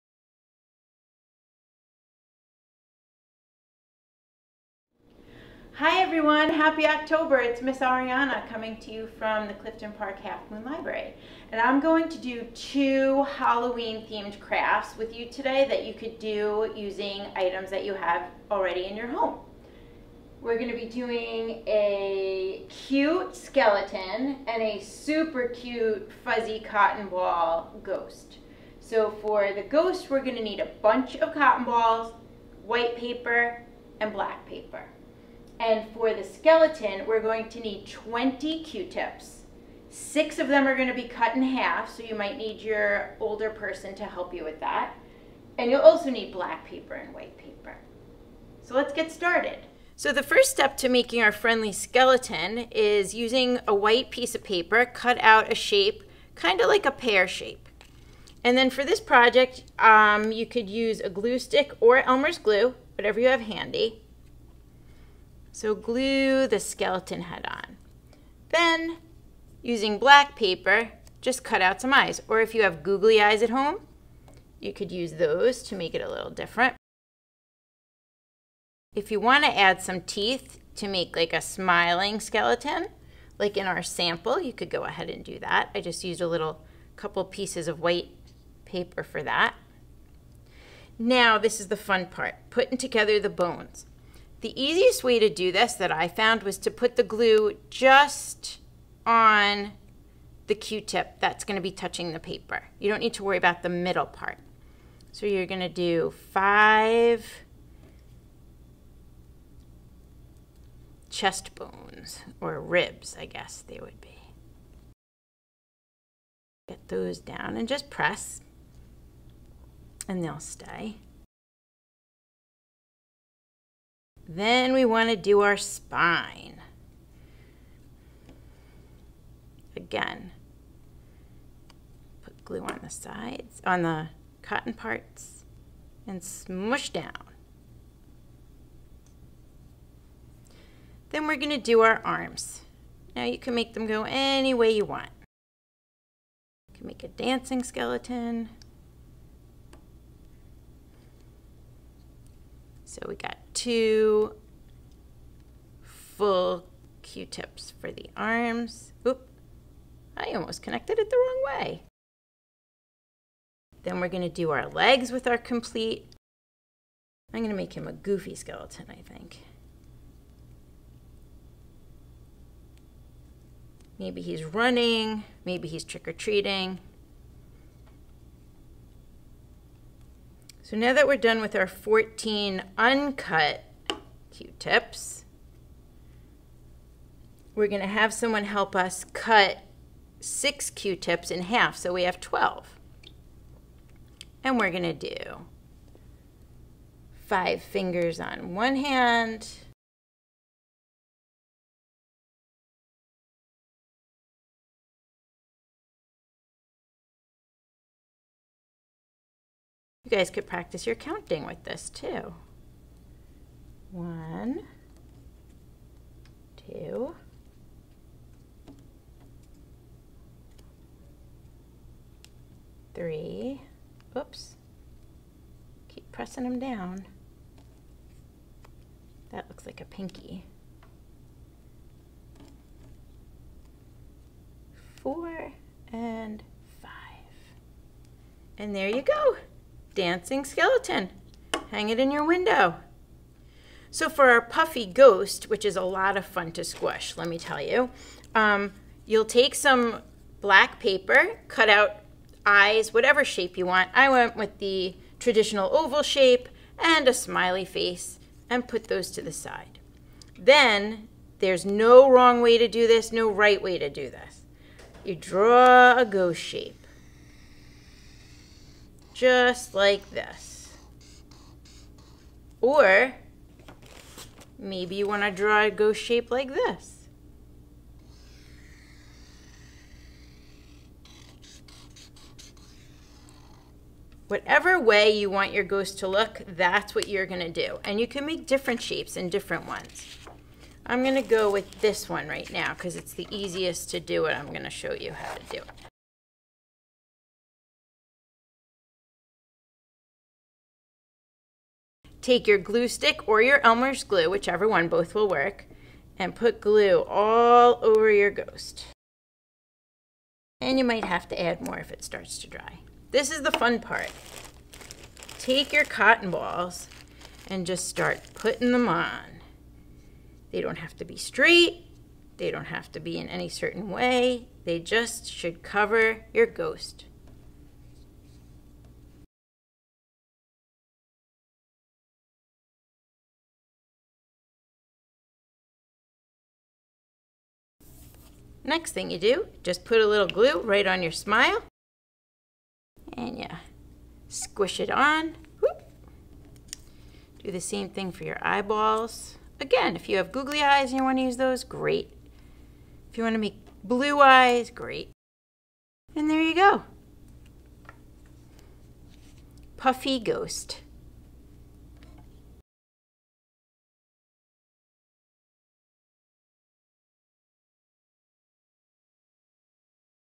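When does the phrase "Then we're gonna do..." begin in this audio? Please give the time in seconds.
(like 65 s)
163 s.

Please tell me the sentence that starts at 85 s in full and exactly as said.
I just used a little couple pieces of white paper for that.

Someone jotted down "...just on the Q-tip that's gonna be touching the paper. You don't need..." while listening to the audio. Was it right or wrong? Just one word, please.
right.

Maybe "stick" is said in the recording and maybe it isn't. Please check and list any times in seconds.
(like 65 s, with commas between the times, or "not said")
61 s, 302 s.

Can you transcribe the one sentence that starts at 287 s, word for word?
And you can make different shapes and different ones.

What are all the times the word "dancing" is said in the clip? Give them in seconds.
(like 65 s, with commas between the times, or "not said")
147 s, 239 s.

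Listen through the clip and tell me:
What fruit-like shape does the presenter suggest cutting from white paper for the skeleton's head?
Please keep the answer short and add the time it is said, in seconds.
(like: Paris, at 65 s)
pear shape, at 56 s.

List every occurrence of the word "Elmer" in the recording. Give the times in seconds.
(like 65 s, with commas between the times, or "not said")
61 s, 303 s.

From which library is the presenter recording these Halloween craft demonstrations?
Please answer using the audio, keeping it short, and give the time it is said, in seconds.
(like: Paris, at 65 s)
Clifton Park Half Moon Library, at 9 s.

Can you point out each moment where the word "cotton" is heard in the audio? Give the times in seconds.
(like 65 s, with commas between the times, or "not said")
26 s, 31 s, 134 s, 315 s.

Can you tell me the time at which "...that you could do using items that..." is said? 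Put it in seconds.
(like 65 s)
15 s.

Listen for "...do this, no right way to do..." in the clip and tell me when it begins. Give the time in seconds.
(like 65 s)
262 s.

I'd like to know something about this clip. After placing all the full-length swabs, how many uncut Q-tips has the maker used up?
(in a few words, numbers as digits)
14.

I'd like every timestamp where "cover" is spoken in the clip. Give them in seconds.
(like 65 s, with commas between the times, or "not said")
325 s.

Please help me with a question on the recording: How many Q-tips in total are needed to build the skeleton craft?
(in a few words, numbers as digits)
20.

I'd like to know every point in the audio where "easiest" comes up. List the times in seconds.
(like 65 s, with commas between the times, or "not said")
94 s, 293 s.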